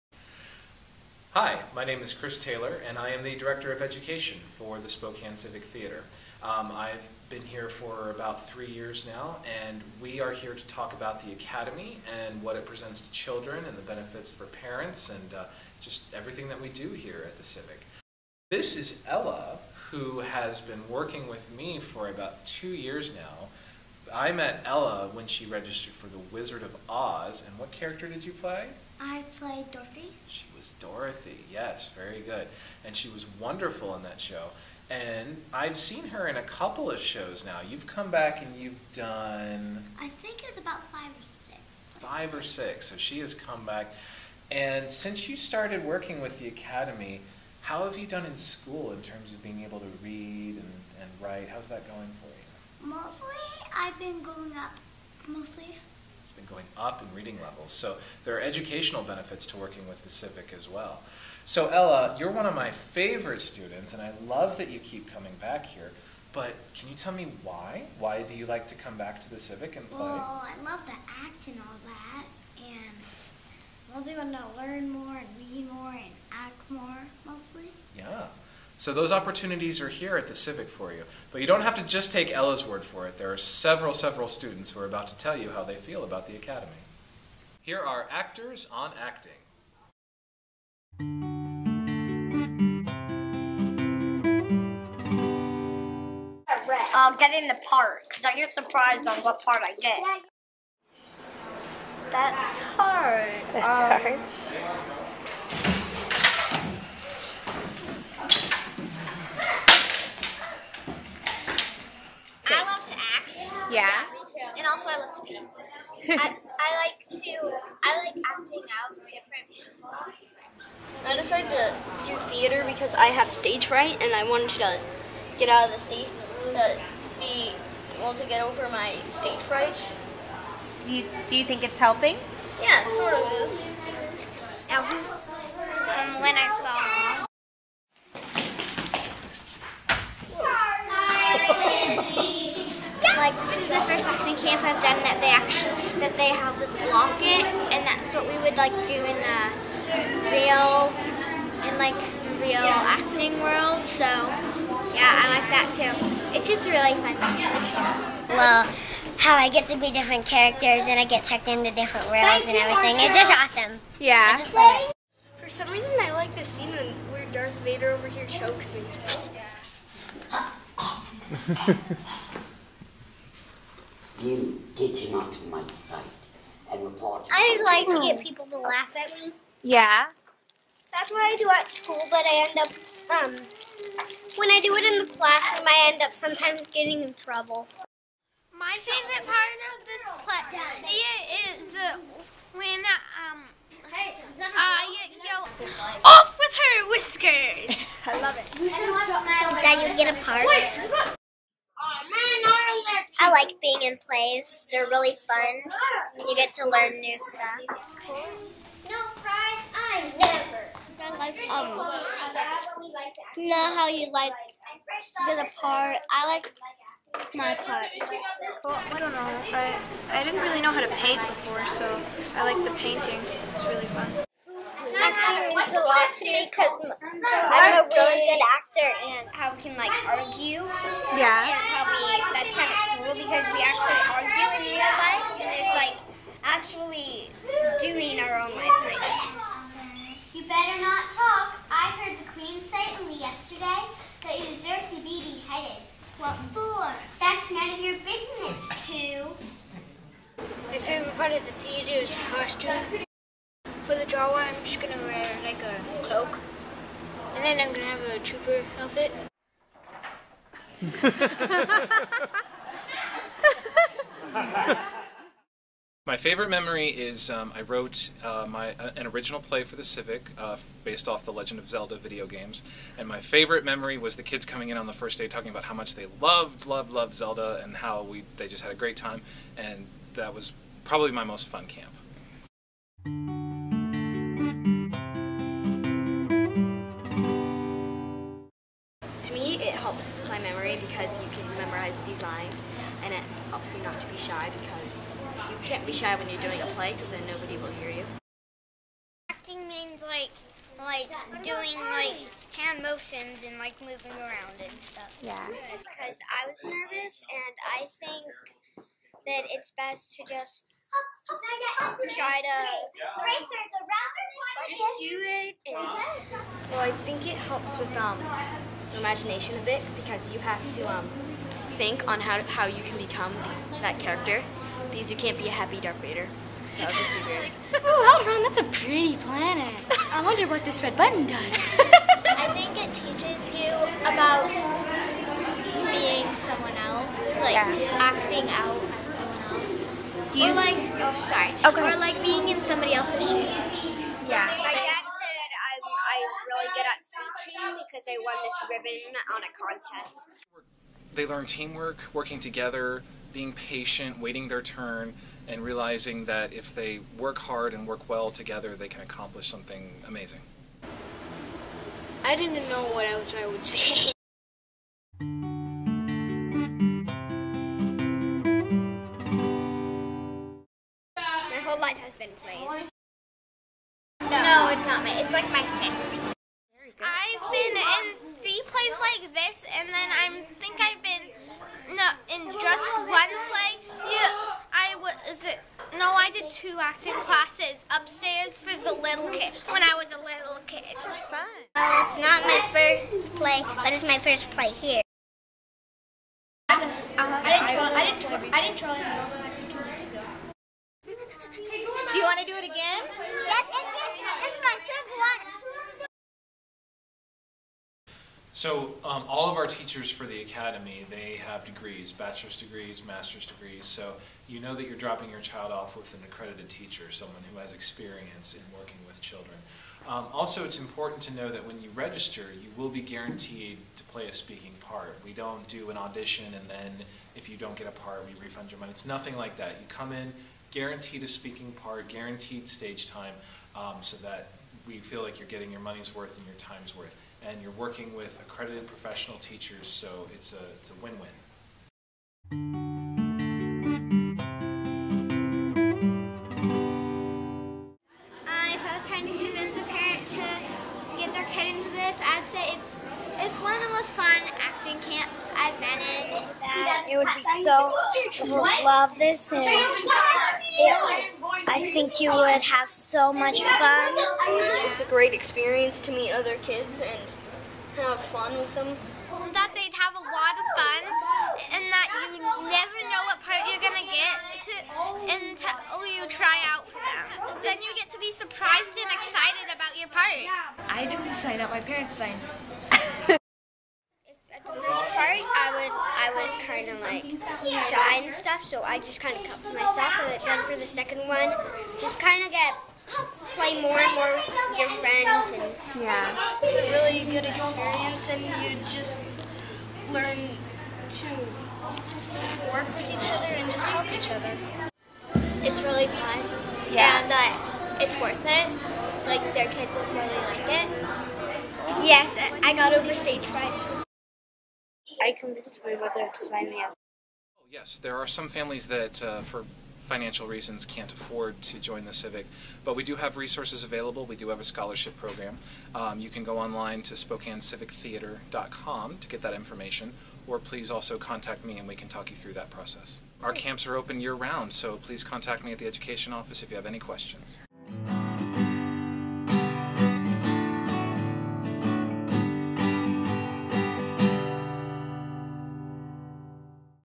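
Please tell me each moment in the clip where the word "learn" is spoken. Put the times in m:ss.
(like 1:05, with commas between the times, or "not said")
1:14, 3:26, 5:51, 8:20.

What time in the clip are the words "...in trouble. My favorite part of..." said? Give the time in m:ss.
3:07.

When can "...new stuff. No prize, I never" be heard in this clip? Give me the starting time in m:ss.
3:26.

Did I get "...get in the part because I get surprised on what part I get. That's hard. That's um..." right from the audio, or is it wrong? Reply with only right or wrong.
right.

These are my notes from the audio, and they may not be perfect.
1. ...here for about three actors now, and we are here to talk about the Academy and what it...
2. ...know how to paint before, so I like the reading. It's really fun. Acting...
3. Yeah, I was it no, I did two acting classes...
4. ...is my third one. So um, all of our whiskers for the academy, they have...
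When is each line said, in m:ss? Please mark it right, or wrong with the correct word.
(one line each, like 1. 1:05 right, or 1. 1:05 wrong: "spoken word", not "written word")
1. 0:07 wrong: "years", not "actors"
2. 3:40 wrong: "painting", not "reading"
3. 6:24 right
4. 6:44 wrong: "teachers", not "whiskers".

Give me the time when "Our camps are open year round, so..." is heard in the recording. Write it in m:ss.
8:53.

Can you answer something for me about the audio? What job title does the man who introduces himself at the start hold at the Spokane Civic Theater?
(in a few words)
Director of Education.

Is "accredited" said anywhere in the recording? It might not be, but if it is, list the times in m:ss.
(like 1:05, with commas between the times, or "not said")
6:56, 7:18.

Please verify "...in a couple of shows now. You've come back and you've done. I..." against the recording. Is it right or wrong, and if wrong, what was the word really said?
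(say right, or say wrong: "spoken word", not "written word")
right.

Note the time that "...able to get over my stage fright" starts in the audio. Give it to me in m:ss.
2:07.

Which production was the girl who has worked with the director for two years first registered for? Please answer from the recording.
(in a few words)
The Wizard of Oz.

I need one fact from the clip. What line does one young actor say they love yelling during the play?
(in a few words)
Off with her whiskers!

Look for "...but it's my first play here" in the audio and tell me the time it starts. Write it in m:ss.
6:33.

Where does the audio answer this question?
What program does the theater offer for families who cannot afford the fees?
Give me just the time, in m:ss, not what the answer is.
8:44.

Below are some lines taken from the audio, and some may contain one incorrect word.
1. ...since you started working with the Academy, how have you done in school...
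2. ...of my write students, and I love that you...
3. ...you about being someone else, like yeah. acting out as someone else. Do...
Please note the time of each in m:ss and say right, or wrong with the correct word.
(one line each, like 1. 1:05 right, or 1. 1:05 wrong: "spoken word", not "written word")
1. 0:44 right
2. 1:02 wrong: "favorite", not "write"
3. 5:33 right.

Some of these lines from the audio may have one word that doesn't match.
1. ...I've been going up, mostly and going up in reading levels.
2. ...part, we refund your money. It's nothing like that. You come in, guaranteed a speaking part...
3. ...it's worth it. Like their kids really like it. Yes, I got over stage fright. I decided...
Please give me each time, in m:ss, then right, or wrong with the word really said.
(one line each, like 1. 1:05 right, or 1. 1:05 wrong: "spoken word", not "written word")
1. 0:53 right
2. 7:07 right
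3. 8:28 wrong: "convinced", not "decided".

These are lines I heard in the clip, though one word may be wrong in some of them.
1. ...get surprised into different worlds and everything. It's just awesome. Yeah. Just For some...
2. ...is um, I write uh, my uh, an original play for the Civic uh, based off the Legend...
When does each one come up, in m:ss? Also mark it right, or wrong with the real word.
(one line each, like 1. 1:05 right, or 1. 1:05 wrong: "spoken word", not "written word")
1. 2:41 wrong: "checked", not "surprised"
2. 4:26 wrong: "wrote", not "write".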